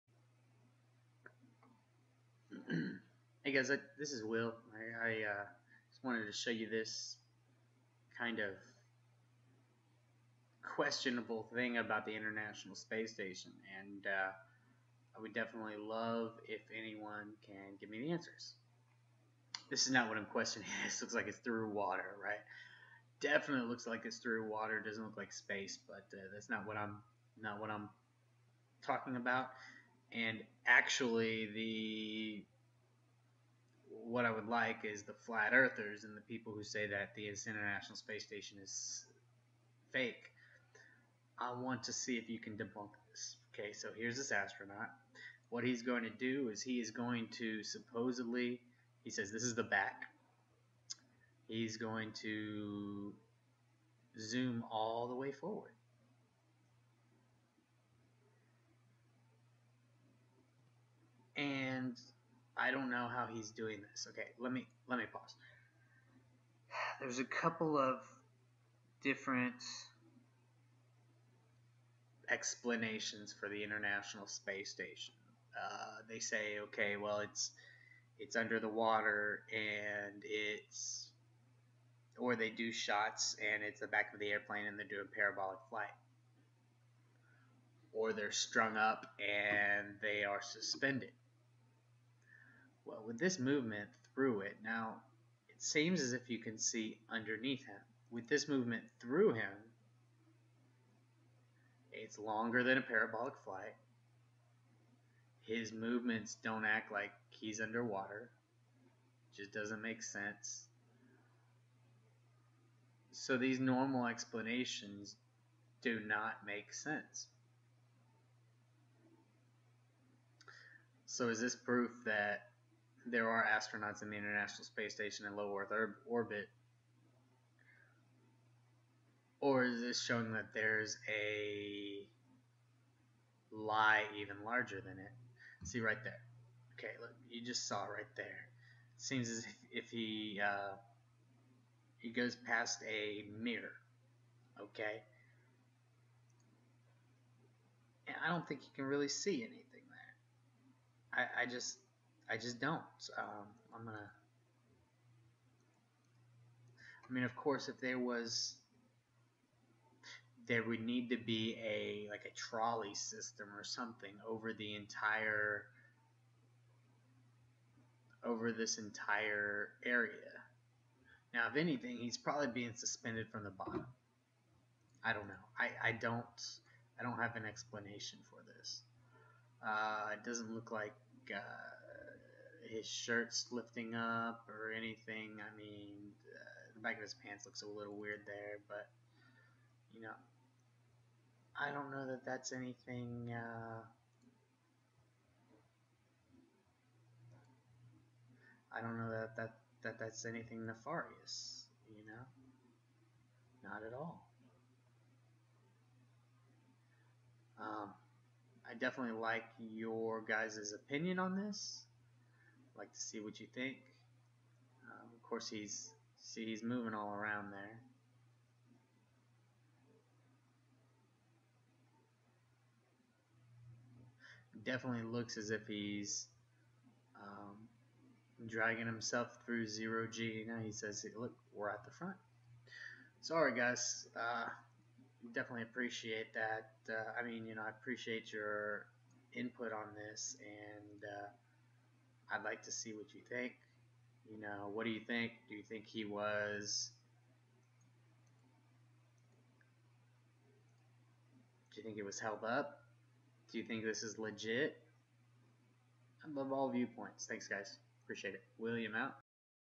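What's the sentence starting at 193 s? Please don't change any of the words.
Uh, I don't know that, that that that's anything nefarious.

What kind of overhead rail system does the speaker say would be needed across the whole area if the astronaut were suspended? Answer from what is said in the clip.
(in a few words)
a trolley system.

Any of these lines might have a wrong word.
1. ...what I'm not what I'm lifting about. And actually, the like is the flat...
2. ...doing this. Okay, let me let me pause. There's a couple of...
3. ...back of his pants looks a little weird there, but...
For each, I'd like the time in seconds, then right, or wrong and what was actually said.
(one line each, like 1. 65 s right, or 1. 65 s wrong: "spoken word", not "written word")
1. 26 s wrong: "talking", not "lifting"
2. 63 s right
3. 186 s right.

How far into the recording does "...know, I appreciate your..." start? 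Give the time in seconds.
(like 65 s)
237 s.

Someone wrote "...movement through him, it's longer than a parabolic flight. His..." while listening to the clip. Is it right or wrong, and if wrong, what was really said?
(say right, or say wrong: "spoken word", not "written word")
right.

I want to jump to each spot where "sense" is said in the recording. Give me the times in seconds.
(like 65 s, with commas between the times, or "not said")
110 s, 116 s.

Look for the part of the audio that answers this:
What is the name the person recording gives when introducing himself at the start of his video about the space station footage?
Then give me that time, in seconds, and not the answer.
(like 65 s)
4 s.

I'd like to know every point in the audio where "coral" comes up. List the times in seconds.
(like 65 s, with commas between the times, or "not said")
not said.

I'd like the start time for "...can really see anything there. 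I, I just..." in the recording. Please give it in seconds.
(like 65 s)
148 s.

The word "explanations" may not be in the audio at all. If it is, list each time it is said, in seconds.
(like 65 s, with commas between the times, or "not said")
72 s, 114 s, 177 s.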